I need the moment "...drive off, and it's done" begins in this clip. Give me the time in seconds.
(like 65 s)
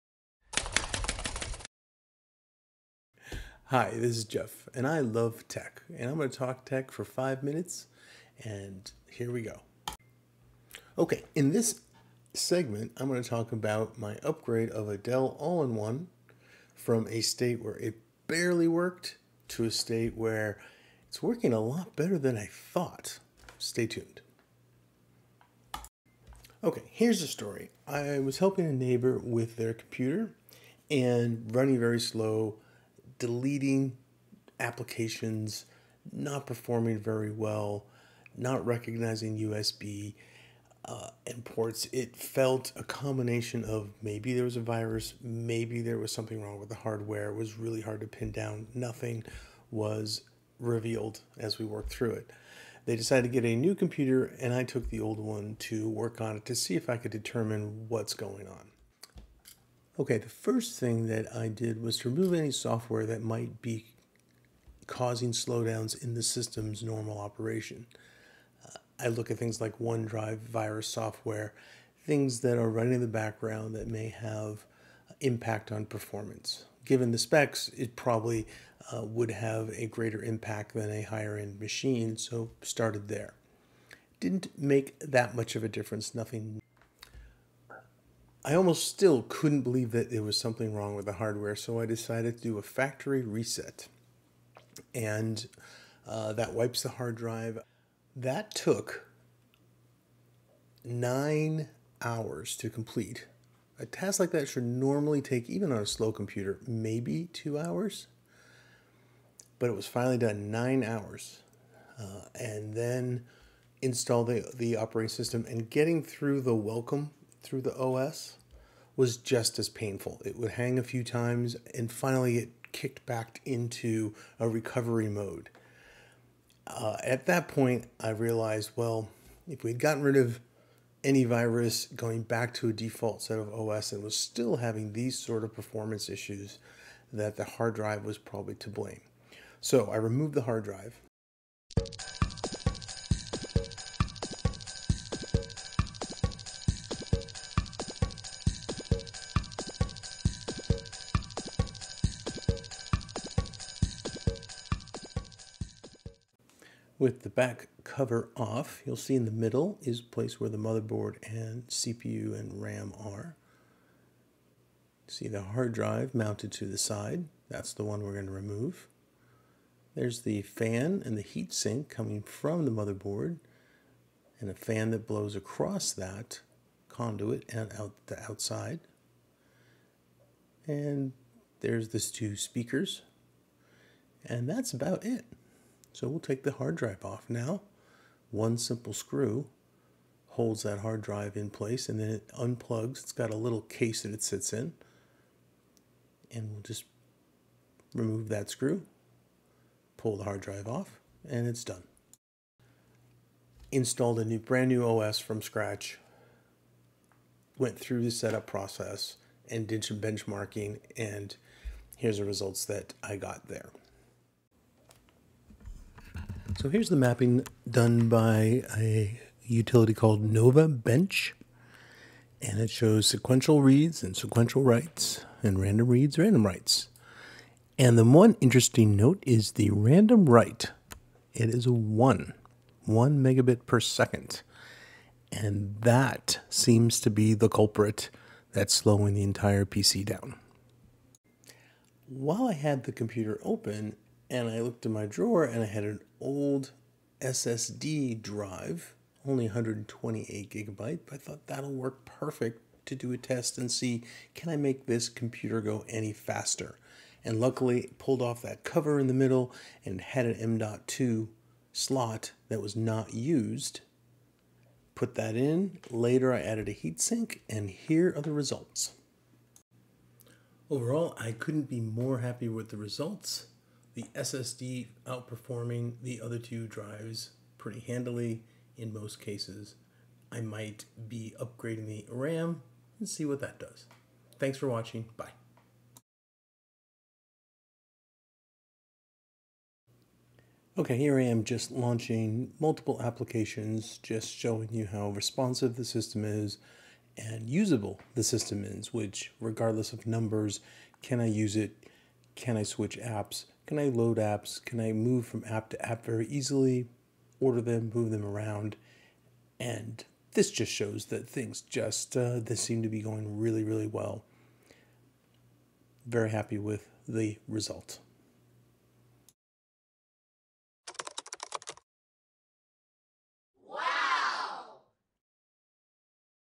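200 s.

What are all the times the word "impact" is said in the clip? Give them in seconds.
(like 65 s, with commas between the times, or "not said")
75 s, 80 s.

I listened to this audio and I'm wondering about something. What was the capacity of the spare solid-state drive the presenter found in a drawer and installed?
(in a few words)
128 gigabytes.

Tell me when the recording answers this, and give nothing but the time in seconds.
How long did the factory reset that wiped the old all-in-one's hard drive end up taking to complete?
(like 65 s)
100 s.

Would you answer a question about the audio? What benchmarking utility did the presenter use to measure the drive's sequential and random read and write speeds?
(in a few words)
Novabench.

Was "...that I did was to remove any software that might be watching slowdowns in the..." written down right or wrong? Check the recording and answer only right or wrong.
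wrong.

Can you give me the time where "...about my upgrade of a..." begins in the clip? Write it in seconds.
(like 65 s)
13 s.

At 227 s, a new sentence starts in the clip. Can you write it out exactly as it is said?
And the one interesting note is the random write.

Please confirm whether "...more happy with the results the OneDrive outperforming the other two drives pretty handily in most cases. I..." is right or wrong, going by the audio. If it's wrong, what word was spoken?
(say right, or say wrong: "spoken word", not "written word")
wrong: "SSD", not "OneDrive".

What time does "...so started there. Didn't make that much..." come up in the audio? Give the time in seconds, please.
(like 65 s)
82 s.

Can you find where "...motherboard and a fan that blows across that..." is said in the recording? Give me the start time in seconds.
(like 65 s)
172 s.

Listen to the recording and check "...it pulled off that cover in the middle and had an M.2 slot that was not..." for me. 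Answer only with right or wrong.
right.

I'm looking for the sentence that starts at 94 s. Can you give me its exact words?
And uh, that wipes the hard drive.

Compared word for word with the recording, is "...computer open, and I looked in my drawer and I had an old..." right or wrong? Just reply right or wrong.
right.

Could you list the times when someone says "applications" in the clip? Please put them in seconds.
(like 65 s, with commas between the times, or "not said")
34 s, 293 s.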